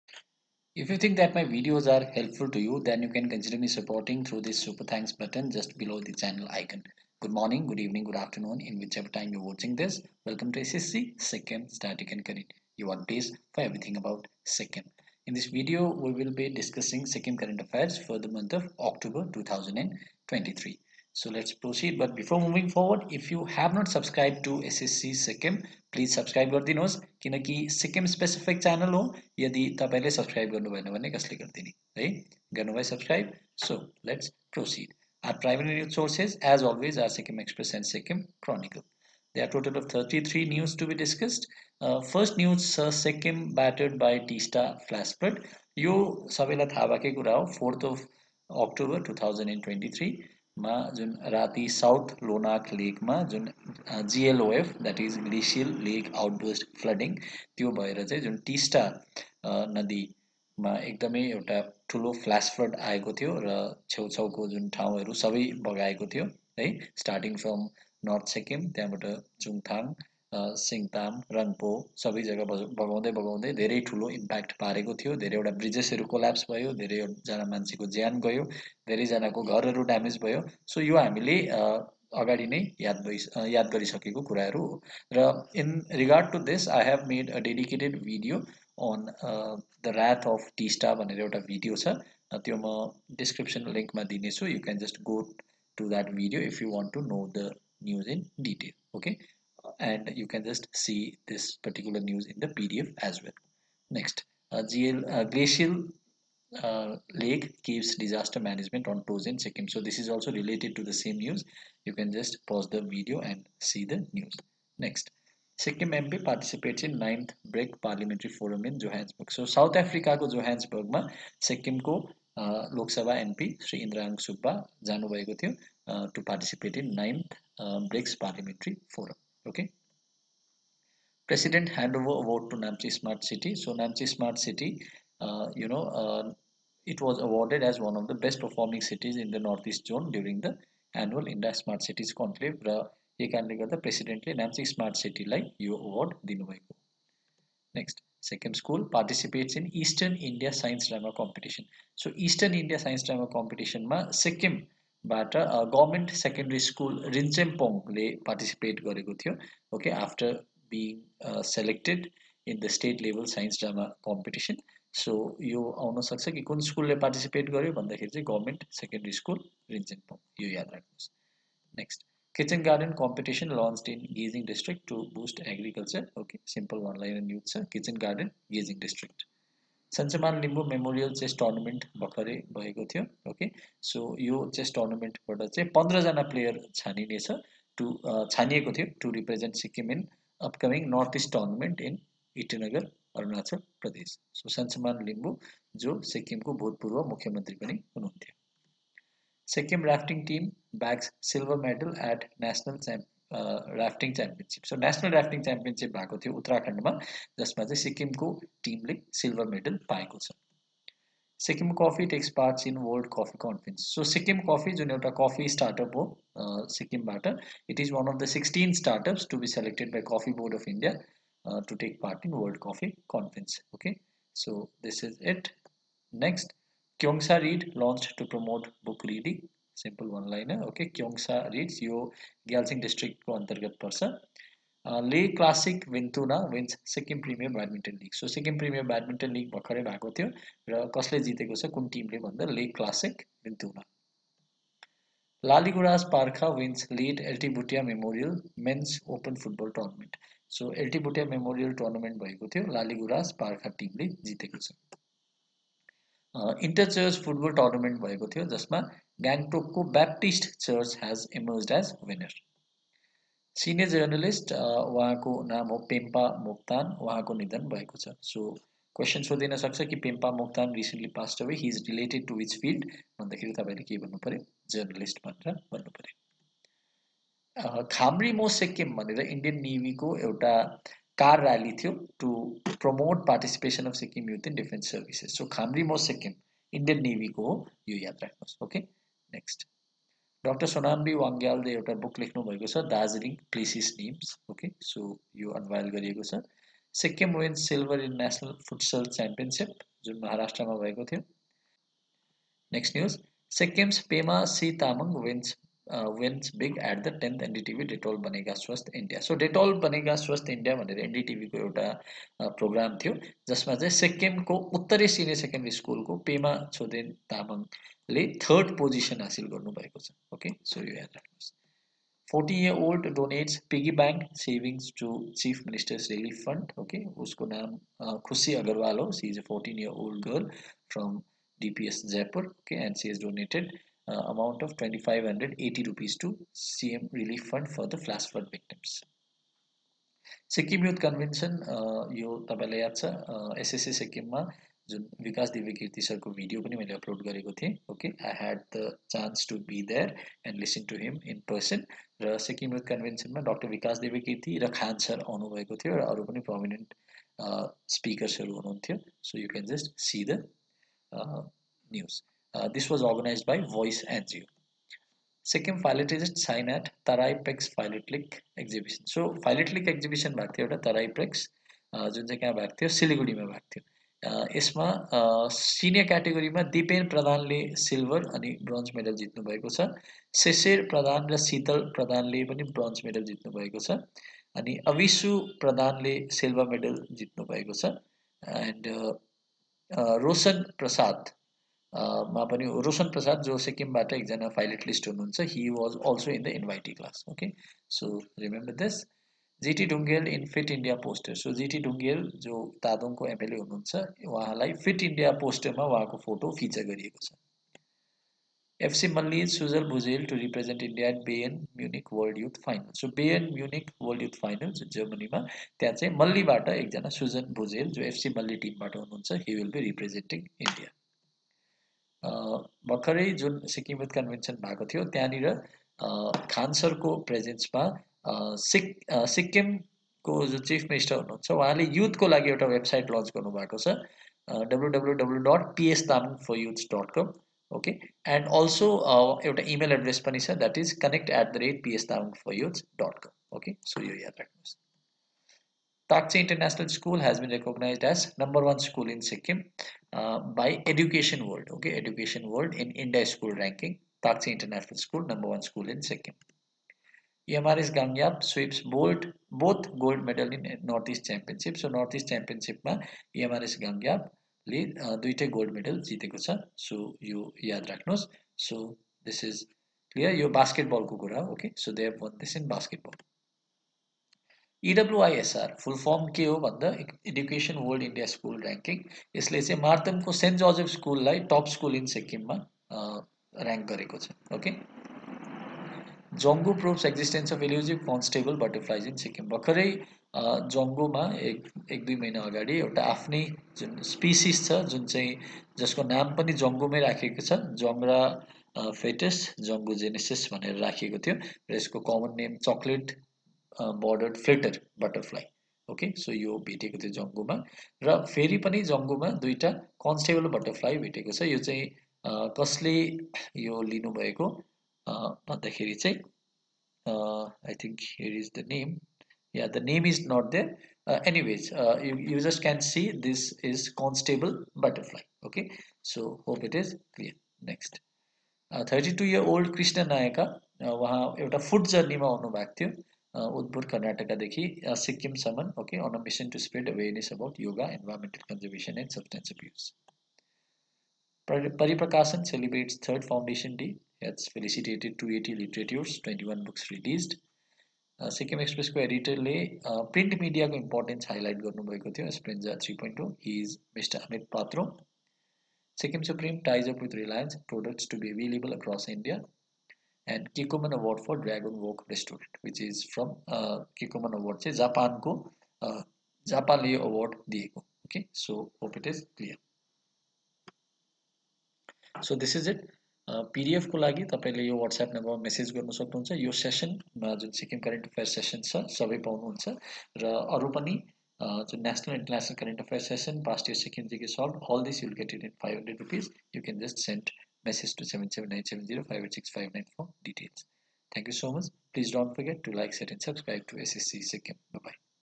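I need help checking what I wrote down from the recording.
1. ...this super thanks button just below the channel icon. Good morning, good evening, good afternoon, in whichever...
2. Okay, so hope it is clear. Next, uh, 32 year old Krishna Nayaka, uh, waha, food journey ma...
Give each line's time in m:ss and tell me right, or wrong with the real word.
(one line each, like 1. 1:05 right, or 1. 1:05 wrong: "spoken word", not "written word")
1. 0:04 right
2. 8:45 right.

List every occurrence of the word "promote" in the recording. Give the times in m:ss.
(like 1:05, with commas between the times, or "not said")
3:48, 4:42.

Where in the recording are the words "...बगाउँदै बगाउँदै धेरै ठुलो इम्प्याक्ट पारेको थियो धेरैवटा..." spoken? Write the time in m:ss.
1:12.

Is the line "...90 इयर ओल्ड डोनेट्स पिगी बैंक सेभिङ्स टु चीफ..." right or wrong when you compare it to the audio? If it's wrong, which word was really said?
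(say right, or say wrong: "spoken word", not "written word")
wrong: "40", not "90".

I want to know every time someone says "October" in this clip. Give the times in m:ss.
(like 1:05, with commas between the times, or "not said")
0:18, 0:48.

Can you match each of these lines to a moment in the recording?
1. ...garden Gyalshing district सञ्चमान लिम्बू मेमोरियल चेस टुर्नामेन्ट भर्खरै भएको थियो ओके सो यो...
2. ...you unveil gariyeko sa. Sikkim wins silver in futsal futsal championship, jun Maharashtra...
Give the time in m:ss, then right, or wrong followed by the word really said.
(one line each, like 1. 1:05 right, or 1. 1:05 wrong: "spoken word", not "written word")
1. 2:57 right
2. 4:55 wrong: "national", not "futsal".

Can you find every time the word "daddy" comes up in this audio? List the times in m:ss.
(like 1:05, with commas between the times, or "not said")
not said.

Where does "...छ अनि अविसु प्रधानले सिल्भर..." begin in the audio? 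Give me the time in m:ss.
6:23.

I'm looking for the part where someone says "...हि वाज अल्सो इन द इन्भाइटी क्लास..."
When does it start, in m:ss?
6:35.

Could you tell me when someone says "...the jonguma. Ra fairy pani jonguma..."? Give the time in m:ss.
8:26.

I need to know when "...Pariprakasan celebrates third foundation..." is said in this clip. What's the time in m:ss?
9:01.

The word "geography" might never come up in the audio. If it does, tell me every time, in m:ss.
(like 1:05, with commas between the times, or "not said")
not said.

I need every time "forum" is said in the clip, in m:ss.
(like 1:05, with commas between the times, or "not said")
1:58, 2:08.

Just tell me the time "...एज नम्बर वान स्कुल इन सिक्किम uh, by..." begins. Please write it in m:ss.
7:28.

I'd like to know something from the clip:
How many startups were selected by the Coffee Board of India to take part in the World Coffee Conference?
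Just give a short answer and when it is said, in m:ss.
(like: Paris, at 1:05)
16, at 3:38.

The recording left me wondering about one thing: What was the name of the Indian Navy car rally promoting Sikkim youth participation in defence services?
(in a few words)
Khamri Mo Sikkim.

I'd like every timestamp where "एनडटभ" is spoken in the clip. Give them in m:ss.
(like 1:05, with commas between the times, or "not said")
5:07.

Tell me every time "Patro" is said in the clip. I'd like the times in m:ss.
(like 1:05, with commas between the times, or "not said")
9:14.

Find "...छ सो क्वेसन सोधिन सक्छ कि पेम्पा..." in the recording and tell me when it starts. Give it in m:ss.
4:28.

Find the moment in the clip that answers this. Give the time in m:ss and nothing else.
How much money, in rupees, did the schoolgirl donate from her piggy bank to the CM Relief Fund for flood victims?
5:34.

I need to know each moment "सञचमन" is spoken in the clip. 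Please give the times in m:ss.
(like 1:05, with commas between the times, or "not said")
2:59, 3:14.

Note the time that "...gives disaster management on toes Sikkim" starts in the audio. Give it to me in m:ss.
1:47.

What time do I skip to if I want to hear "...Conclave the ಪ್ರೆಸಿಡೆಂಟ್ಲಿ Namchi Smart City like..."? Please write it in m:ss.
2:22.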